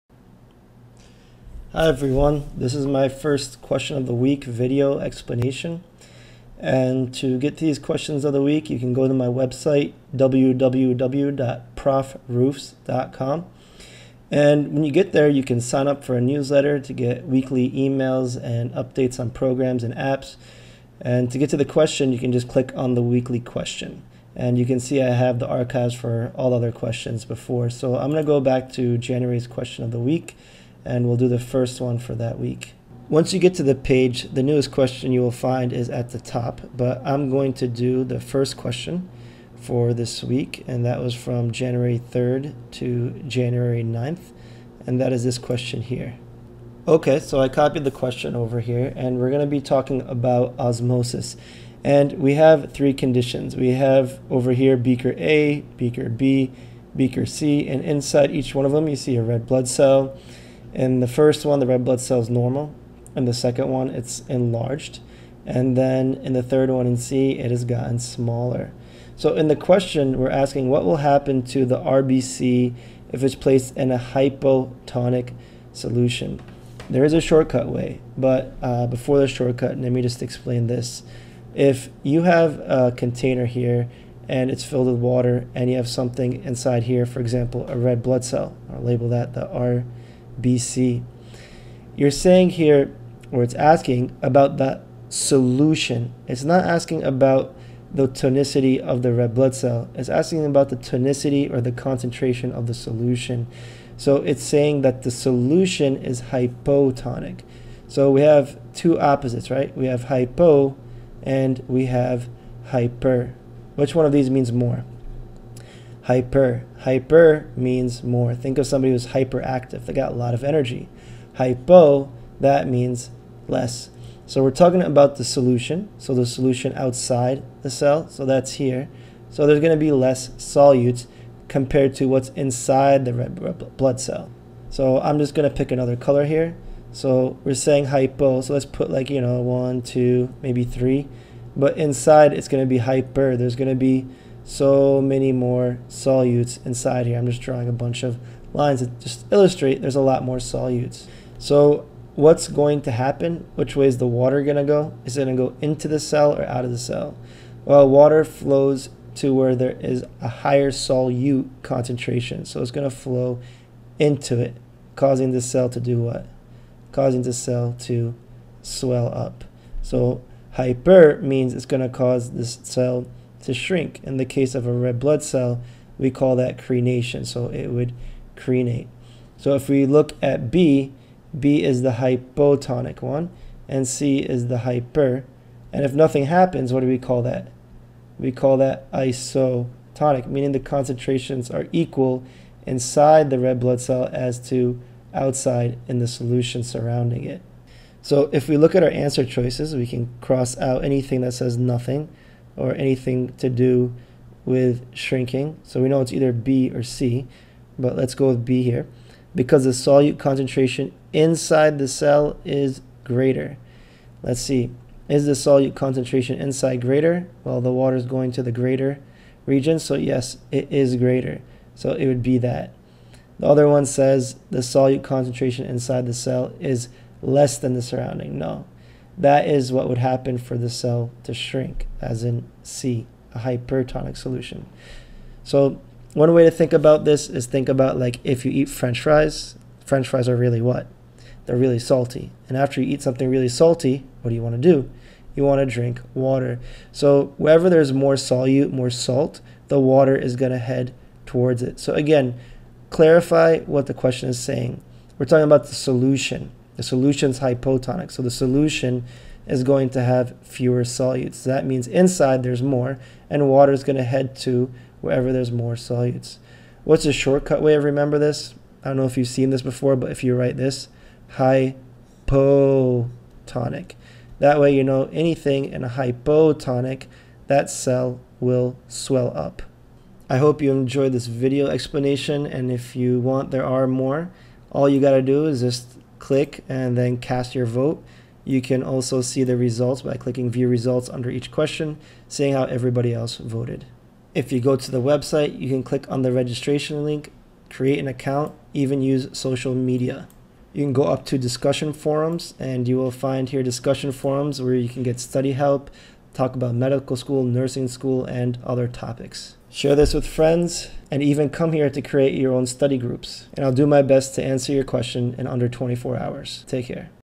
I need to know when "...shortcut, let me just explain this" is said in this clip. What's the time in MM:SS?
01:19.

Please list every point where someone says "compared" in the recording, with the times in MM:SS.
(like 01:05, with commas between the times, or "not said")
02:11.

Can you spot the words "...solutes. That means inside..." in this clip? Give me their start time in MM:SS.
04:20.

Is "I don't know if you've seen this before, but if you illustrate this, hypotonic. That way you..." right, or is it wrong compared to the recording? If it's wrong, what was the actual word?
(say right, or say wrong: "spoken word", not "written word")
wrong: "write", not "illustrate".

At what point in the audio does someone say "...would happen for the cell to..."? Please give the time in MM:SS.
03:49.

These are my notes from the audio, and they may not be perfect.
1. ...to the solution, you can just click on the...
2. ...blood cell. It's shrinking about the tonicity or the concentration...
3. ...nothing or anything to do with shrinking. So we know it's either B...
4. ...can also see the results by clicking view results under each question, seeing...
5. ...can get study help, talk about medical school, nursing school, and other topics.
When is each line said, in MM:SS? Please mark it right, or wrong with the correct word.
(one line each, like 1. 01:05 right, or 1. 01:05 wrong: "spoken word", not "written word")
1. 00:21 wrong: "question", not "solution"
2. 01:39 wrong: "asking", not "shrinking"
3. 03:21 right
4. 04:48 right
5. 05:04 right.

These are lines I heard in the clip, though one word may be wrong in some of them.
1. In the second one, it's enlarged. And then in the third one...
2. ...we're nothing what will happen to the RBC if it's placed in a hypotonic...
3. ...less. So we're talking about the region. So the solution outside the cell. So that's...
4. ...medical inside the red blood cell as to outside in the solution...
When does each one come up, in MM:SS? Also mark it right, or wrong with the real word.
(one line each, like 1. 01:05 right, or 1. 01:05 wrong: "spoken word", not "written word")
1. 01:03 right
2. 01:10 wrong: "asking", not "nothing"
3. 02:03 wrong: "solution", not "region"
4. 03:11 wrong: "equal", not "medical".